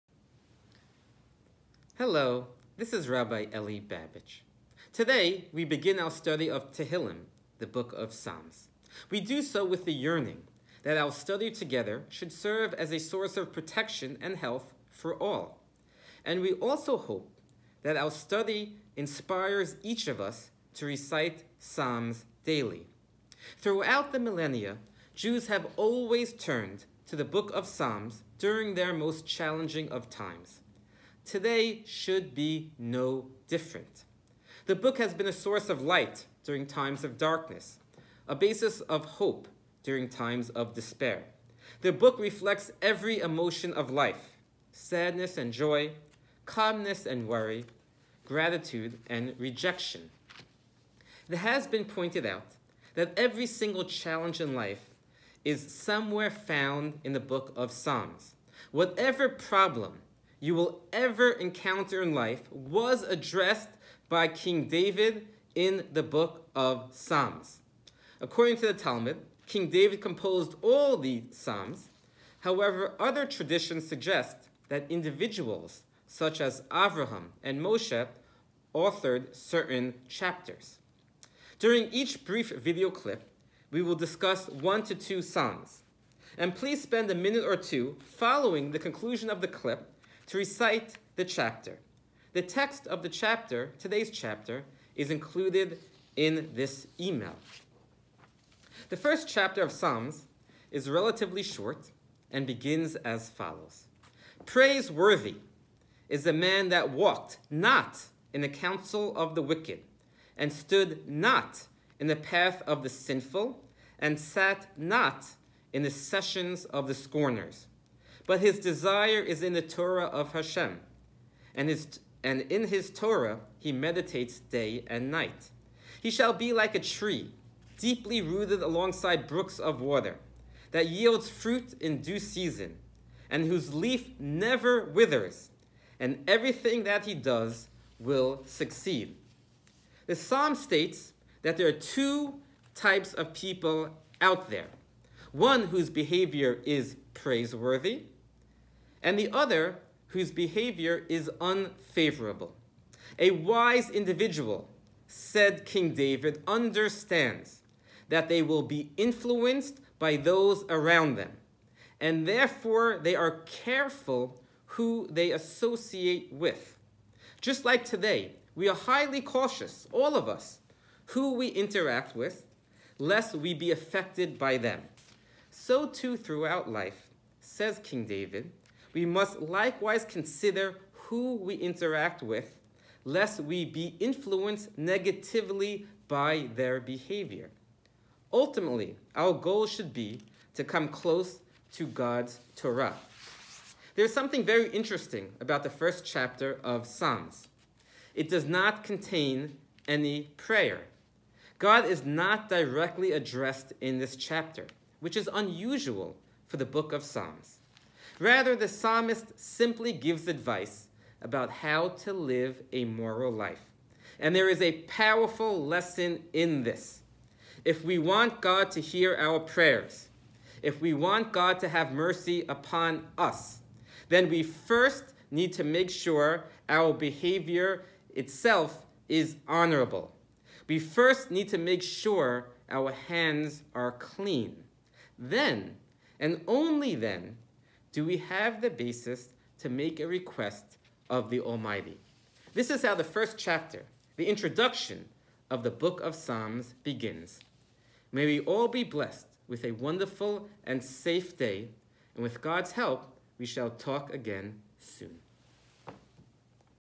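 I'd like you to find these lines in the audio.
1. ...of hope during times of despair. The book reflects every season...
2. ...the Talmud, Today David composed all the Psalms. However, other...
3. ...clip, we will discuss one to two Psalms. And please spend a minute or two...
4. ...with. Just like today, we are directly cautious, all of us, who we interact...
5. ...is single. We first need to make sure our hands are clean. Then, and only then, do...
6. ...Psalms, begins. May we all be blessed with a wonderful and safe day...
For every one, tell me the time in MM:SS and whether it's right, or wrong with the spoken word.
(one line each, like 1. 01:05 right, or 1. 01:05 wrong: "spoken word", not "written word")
1. 00:38 wrong: "emotion", not "season"
2. 01:08 wrong: "King", not "Today"
3. 01:22 right
4. 02:46 wrong: "highly", not "directly"
5. 03:49 wrong: "honorable", not "single"
6. 04:06 right.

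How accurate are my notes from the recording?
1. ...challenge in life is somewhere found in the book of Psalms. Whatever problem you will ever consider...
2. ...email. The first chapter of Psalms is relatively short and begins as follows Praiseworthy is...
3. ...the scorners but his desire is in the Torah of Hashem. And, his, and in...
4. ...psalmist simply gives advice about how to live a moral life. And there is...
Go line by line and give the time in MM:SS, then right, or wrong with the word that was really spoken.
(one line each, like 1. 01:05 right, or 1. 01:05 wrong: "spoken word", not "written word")
1. 00:53 wrong: "encounter", not "consider"
2. 01:36 right
3. 01:56 right
4. 03:28 right.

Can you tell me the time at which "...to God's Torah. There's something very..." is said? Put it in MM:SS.
03:11.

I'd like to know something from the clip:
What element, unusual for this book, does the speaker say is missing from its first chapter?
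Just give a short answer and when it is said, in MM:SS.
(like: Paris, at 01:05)
Prayer, at 03:18.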